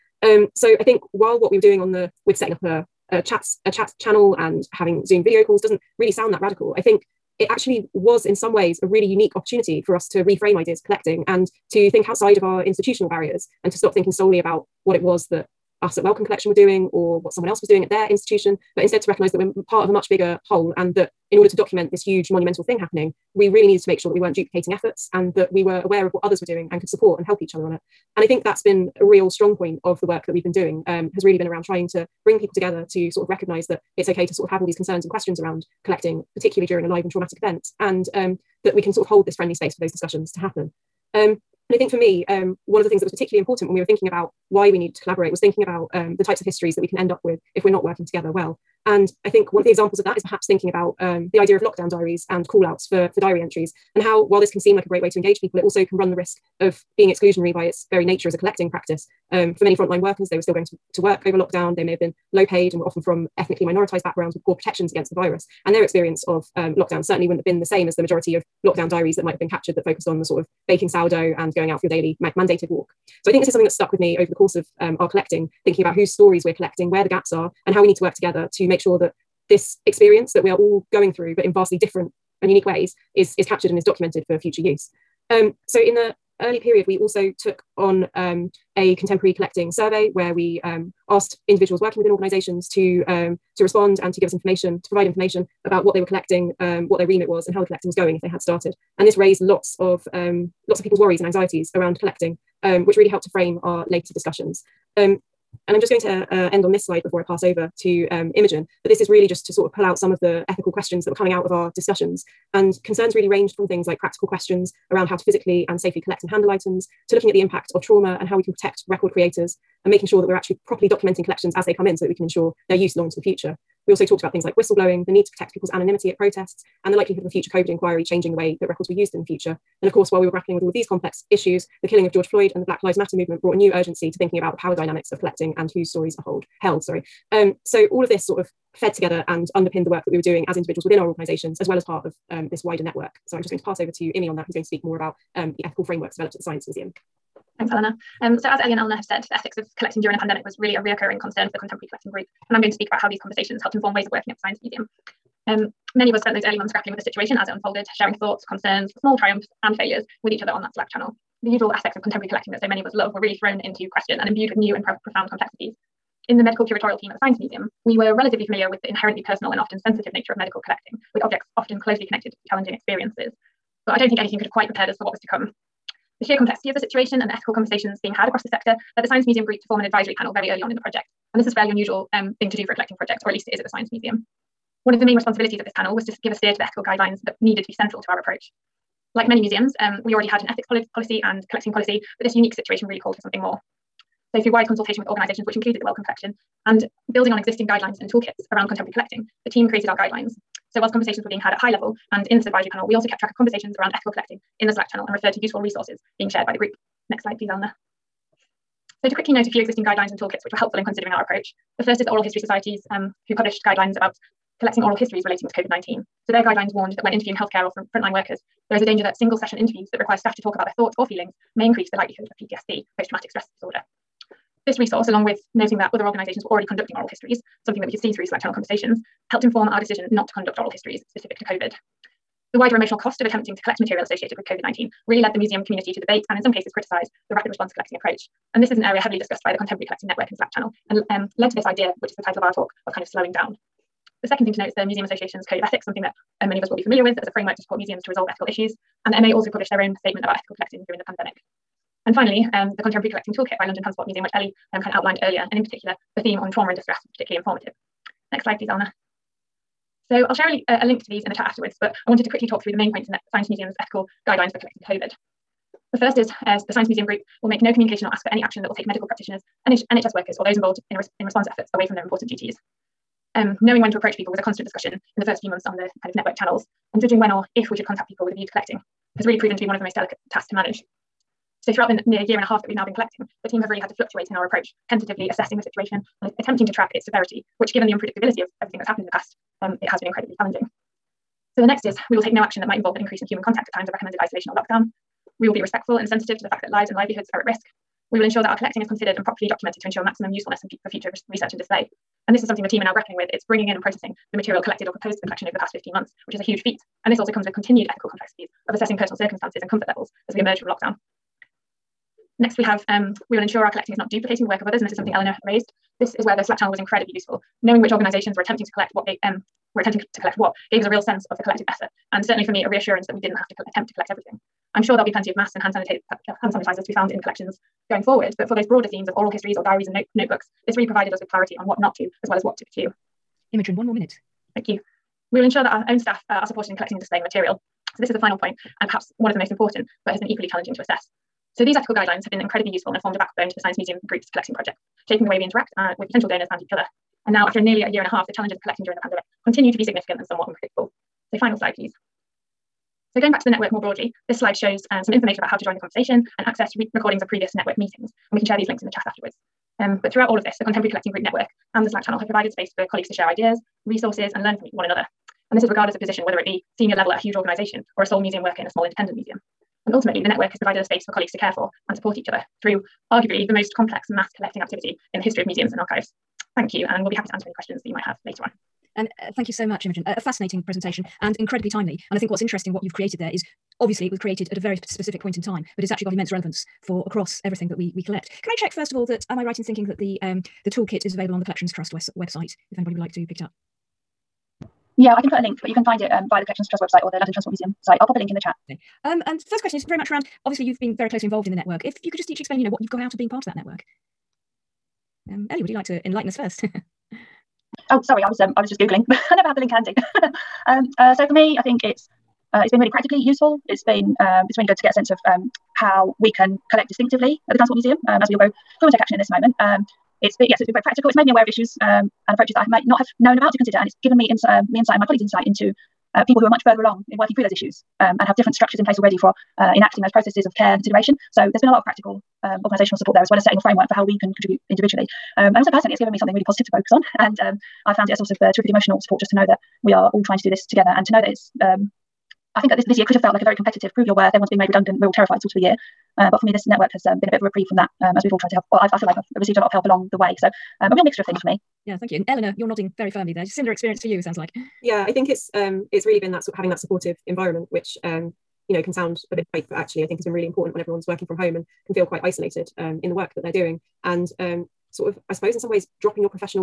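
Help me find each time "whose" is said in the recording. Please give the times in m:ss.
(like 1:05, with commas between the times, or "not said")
1:15, 2:15.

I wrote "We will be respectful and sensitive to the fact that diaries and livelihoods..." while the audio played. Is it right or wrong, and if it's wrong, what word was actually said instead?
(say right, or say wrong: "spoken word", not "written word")
wrong: "lives", not "diaries".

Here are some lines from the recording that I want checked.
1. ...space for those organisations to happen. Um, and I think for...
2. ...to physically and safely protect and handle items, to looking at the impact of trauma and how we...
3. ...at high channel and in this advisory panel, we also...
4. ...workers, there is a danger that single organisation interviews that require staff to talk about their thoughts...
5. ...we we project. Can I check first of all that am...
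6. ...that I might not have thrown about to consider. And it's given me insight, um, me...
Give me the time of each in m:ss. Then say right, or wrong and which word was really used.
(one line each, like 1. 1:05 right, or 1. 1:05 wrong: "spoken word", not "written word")
1. 0:39 wrong: "discussions", not "organisations"
2. 1:55 wrong: "collect", not "protect"
3. 3:21 wrong: "level", not "channel"
4. 3:38 wrong: "session", not "organisation"
5. 6:27 wrong: "collect", not "project"
6. 7:02 wrong: "known", not "thrown".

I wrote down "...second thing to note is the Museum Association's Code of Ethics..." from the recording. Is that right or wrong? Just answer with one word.
right.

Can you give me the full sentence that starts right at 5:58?
And we can share these links in the chat afterwards.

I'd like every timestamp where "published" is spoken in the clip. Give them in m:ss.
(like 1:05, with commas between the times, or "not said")
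3:33, 4:09.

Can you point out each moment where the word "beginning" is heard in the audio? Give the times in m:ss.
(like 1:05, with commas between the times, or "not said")
not said.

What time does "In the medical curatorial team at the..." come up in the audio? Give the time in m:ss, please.
2:46.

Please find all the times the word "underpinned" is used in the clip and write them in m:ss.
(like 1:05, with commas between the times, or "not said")
2:19.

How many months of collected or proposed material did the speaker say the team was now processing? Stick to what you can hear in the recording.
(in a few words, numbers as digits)
15.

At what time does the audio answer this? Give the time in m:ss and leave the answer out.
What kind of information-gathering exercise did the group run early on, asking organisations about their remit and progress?
1:28.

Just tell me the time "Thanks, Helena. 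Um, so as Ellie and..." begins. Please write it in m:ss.
2:27.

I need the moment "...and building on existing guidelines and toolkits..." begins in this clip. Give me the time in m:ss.
3:16.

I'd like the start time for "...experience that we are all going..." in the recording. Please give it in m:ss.
1:19.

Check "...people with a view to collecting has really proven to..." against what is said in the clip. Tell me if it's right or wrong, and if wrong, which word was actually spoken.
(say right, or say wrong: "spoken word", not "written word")
right.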